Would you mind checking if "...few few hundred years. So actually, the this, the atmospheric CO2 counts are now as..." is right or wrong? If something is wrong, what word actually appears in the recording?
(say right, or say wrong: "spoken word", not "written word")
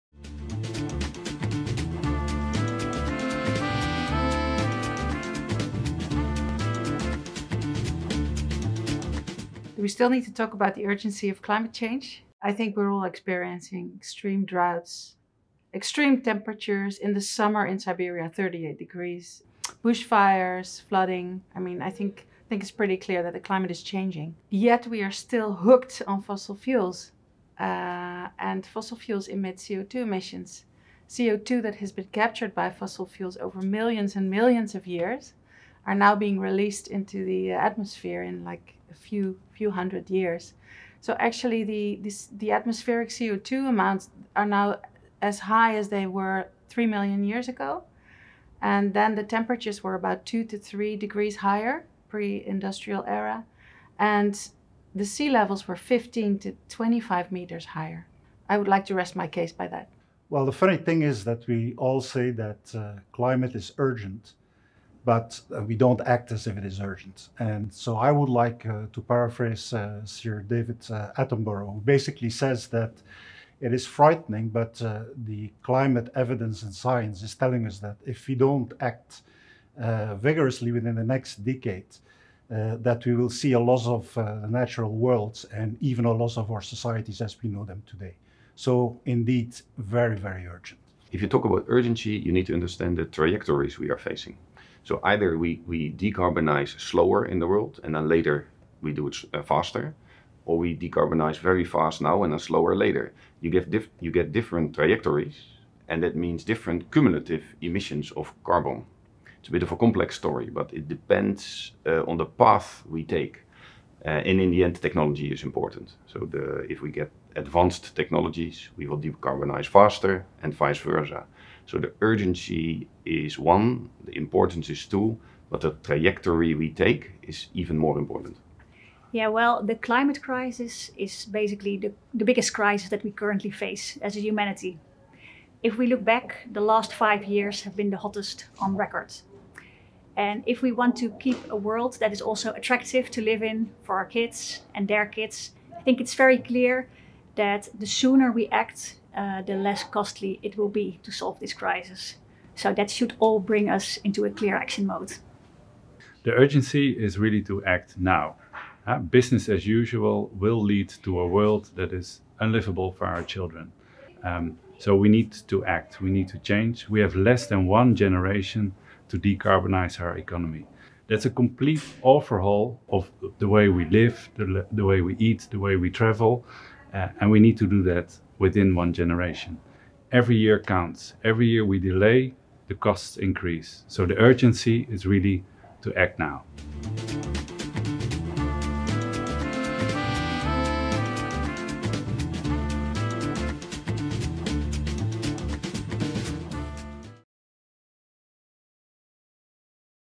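wrong: "amounts", not "counts".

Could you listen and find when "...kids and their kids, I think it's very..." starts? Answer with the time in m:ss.
2:24.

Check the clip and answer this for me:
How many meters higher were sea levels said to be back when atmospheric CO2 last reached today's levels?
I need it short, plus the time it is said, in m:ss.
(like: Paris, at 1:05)
15 to 25 meters, at 0:55.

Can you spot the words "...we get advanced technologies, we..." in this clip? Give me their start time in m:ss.
1:56.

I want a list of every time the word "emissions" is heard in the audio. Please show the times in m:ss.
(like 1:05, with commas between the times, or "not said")
0:29, 1:47.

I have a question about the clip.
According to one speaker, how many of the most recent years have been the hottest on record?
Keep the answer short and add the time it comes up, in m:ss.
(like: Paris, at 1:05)
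5, at 2:16.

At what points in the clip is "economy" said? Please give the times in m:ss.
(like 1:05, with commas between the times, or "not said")
2:50.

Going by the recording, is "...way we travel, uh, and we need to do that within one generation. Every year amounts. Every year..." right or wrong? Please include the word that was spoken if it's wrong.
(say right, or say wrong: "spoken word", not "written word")
wrong: "counts", not "amounts".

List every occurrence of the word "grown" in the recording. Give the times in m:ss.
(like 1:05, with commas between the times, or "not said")
not said.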